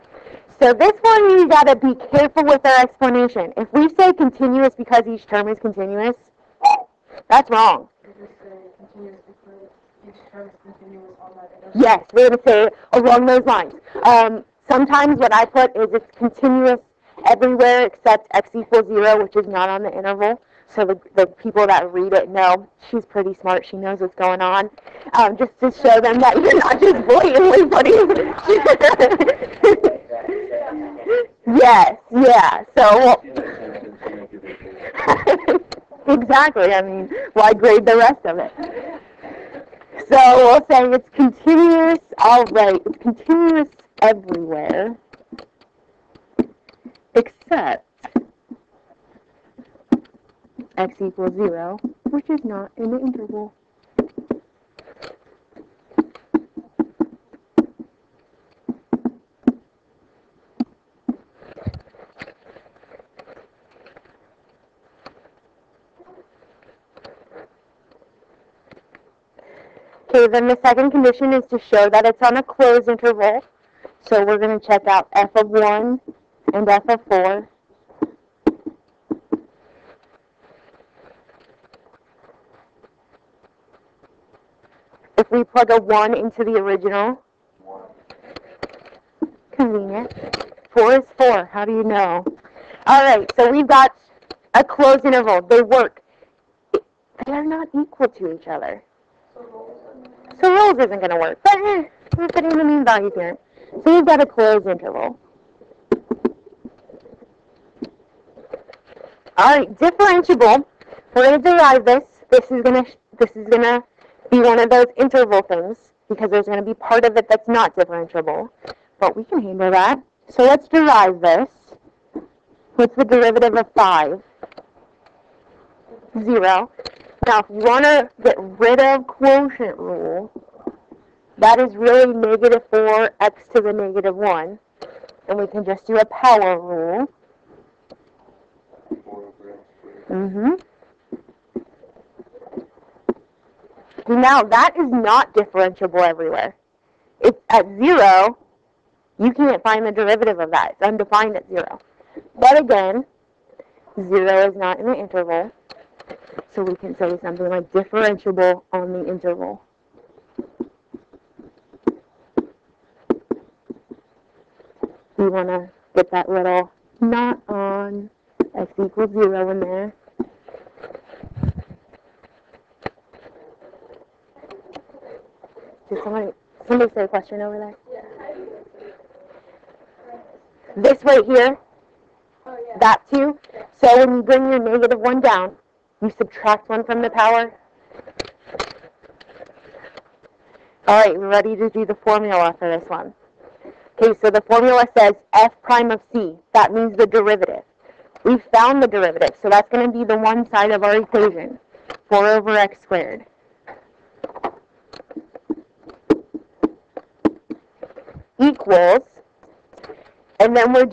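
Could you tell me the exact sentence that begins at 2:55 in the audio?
Did somebody, somebody say a question over there?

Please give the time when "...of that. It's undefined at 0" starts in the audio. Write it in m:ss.
2:30.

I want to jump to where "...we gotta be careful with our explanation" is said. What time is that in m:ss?
0:01.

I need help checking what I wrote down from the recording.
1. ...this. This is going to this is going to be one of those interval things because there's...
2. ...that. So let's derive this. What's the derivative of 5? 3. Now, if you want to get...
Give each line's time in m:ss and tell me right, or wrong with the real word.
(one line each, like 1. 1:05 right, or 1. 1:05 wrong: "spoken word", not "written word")
1. 1:51 right
2. 1:59 wrong: "0", not "3".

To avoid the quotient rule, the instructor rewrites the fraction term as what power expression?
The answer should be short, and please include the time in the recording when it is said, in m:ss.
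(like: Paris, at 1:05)
negative 4x to the negative 1, at 2:12.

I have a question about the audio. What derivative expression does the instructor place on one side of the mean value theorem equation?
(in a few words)
4 over x squared.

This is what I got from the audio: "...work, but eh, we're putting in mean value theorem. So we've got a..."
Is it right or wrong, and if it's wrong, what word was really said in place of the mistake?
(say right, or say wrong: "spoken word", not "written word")
right.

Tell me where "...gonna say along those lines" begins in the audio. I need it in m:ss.
0:12.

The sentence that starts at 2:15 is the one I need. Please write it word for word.
And we can just do a power rule.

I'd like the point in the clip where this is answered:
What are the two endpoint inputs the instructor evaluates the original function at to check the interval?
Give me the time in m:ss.
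1:15.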